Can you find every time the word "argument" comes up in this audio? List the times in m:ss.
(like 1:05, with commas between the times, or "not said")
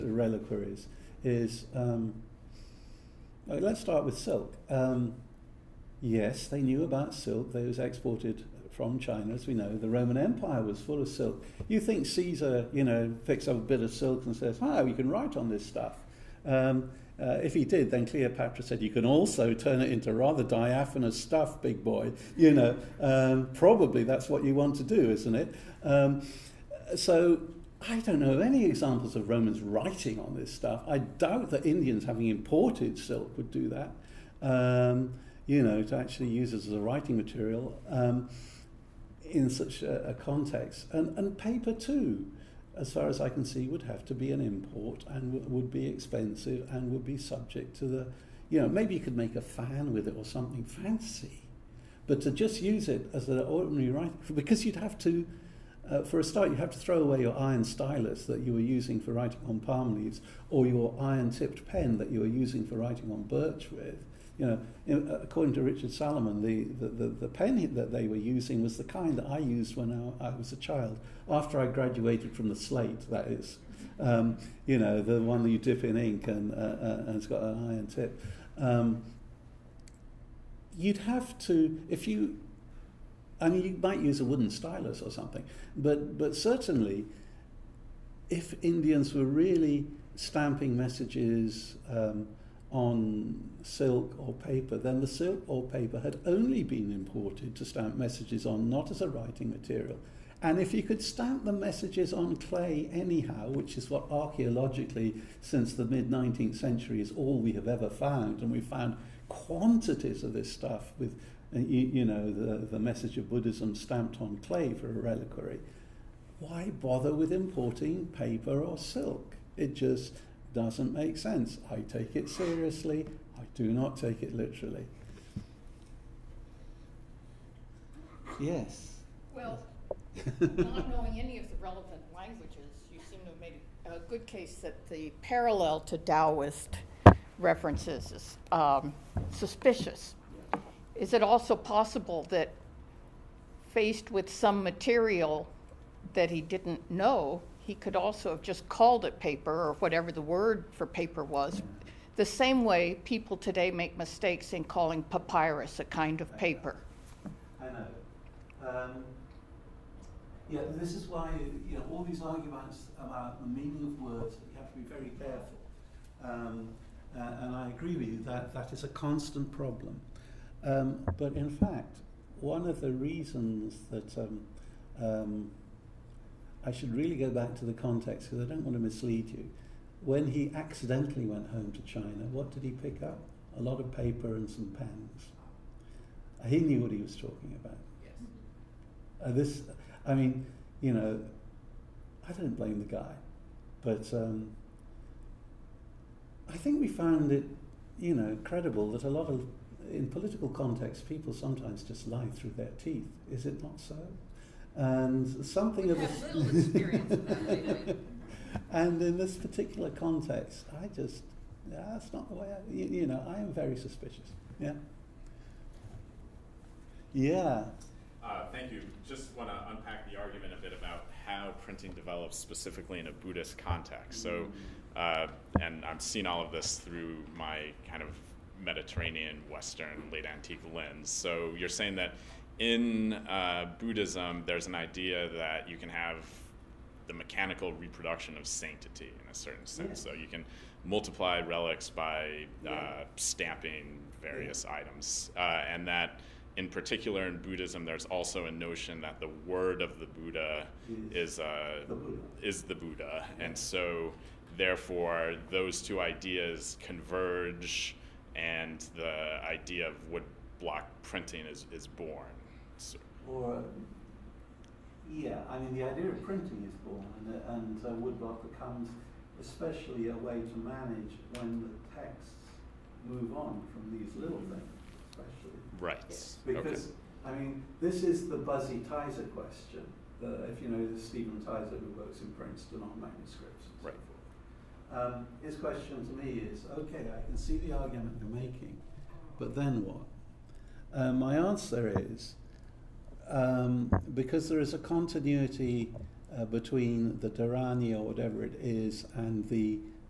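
2:42, 3:40, 4:47.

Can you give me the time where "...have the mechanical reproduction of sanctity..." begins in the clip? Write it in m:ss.
3:55.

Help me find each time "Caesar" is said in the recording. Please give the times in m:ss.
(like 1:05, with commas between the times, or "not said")
0:12.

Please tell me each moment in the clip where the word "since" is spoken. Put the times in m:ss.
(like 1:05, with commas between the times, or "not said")
1:45.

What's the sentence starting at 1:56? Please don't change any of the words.
Why bother with importing paper or silk?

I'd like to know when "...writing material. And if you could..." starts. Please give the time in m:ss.
1:39.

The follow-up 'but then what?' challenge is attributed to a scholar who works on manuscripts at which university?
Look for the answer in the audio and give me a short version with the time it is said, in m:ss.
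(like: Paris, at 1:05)
Princeton, at 4:42.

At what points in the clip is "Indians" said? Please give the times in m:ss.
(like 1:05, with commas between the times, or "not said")
0:31, 1:28.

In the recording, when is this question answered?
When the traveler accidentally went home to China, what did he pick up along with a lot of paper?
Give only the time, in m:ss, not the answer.
3:04.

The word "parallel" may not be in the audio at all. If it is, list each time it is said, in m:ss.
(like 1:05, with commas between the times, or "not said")
2:15.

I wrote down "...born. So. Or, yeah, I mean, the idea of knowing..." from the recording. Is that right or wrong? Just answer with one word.
wrong.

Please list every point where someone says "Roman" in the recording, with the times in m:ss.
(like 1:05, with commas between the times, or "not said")
0:09, 0:29.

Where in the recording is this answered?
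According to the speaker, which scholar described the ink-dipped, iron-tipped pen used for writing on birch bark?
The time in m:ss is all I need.
1:05.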